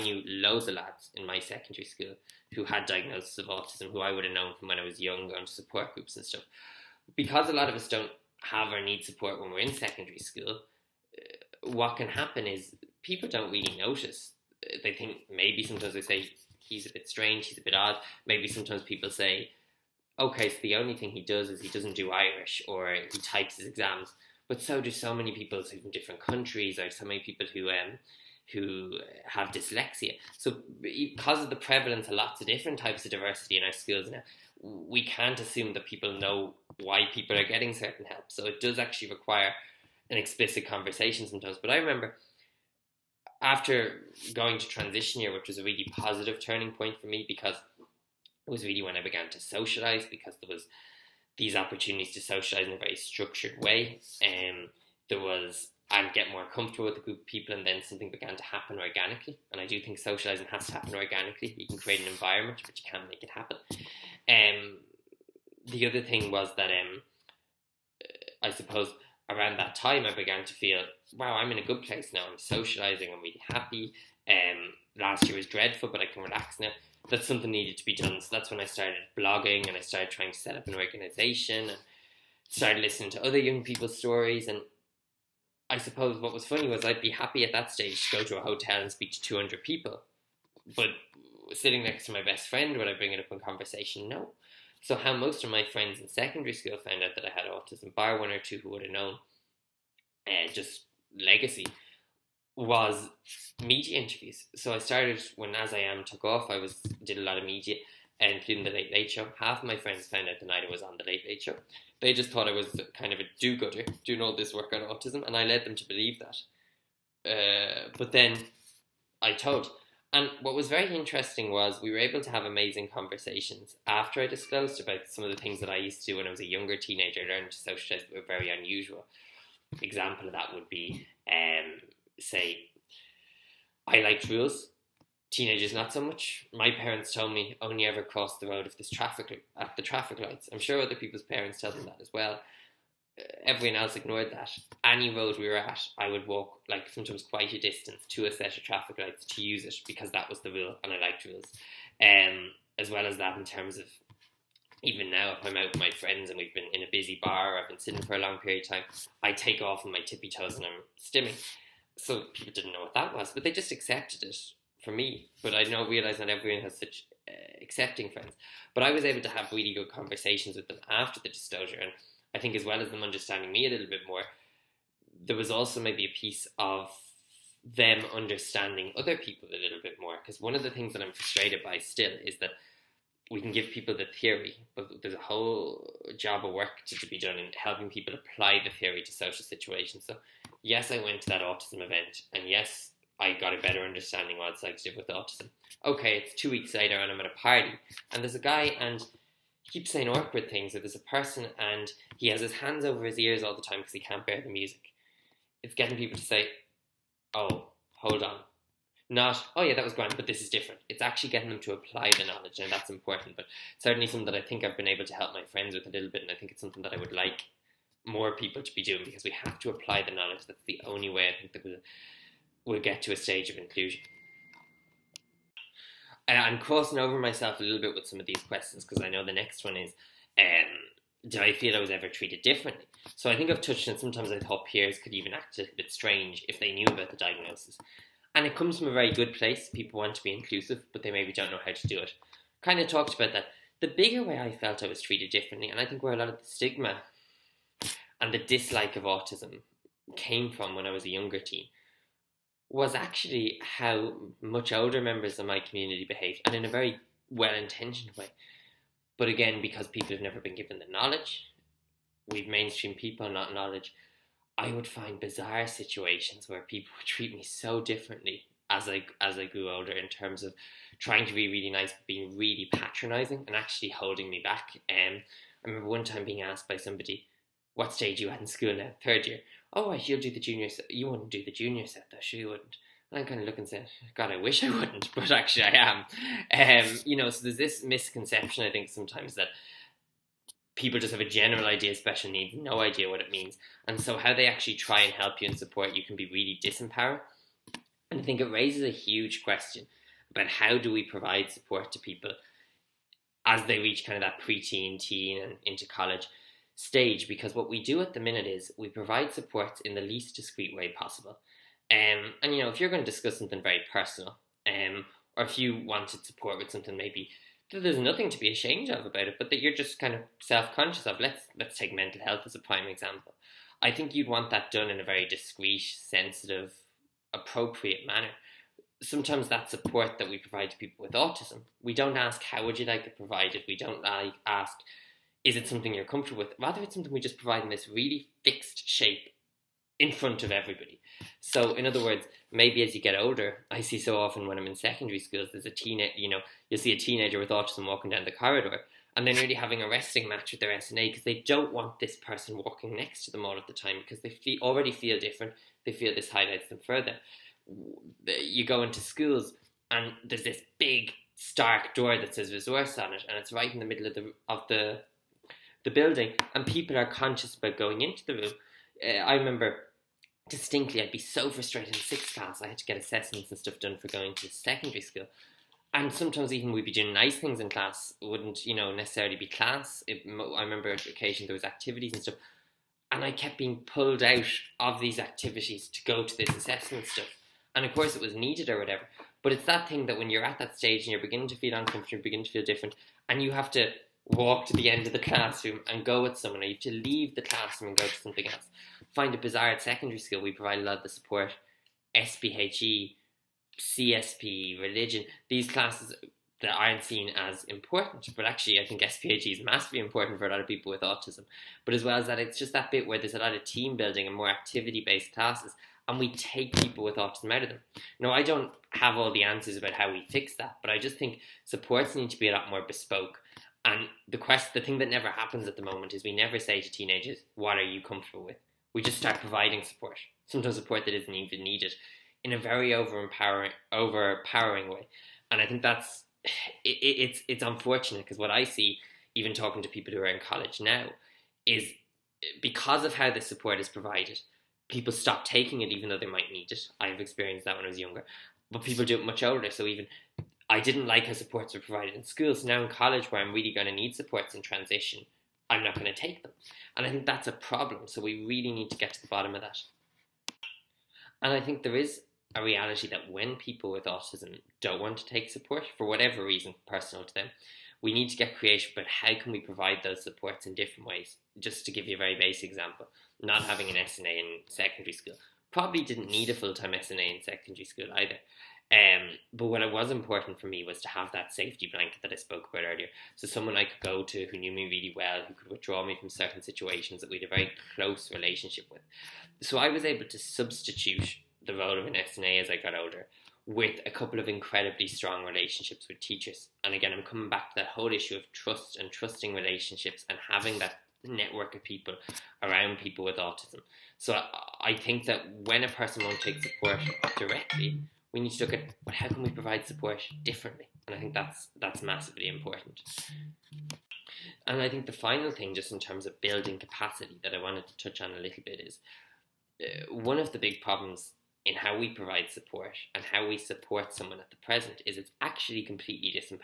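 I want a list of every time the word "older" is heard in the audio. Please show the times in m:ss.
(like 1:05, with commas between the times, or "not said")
4:14, 4:29, 5:43, 7:29, 8:12.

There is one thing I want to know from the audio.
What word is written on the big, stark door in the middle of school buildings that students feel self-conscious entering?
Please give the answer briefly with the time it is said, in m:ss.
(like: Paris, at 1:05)
Resource, at 6:02.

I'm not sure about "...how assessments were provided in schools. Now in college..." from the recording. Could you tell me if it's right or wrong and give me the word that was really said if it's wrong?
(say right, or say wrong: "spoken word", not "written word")
wrong: "supports", not "assessments".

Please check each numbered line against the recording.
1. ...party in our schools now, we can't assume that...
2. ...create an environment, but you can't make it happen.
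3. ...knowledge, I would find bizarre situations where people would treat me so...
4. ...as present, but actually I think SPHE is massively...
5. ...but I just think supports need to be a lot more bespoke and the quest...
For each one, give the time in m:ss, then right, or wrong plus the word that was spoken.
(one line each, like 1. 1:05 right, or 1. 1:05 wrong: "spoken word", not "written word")
1. 0:33 wrong: "diversity", not "party"
2. 1:01 right
3. 4:23 right
4. 6:47 wrong: "important", not "present"
5. 7:00 right.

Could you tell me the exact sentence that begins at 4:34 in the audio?
Um, I remember one time being asked by somebody, "What stage you at in school now?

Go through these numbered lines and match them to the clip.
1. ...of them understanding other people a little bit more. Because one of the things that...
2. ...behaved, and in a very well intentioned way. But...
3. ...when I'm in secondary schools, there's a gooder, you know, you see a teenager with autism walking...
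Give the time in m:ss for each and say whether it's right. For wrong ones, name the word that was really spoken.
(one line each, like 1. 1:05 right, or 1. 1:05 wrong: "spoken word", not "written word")
1. 2:56 right
2. 4:16 right
3. 5:44 wrong: "teenager", not "gooder".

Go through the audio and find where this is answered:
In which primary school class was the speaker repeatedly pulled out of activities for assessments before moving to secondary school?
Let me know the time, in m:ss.
6:12.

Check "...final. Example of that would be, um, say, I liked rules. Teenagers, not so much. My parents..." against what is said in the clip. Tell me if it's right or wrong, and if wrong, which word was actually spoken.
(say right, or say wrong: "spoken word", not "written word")
wrong: "unusual", not "final".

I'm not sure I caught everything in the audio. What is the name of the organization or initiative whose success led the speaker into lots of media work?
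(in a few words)
As I Am.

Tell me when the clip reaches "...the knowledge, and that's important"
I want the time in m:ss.
3:32.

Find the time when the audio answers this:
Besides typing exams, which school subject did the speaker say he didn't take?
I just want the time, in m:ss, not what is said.
0:22.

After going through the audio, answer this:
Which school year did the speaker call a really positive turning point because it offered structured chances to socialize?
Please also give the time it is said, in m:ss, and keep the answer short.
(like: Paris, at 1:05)
Transition year, at 0:44.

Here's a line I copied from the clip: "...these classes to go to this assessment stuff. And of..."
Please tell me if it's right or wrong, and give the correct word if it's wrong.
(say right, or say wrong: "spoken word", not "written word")
wrong: "activities", not "classes".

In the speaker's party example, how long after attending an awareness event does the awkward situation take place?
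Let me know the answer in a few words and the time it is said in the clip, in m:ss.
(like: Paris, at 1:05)
Two weeks, at 3:16.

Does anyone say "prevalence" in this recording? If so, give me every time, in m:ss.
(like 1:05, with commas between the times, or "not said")
0:31.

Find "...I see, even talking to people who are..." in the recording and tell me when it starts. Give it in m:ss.
7:18.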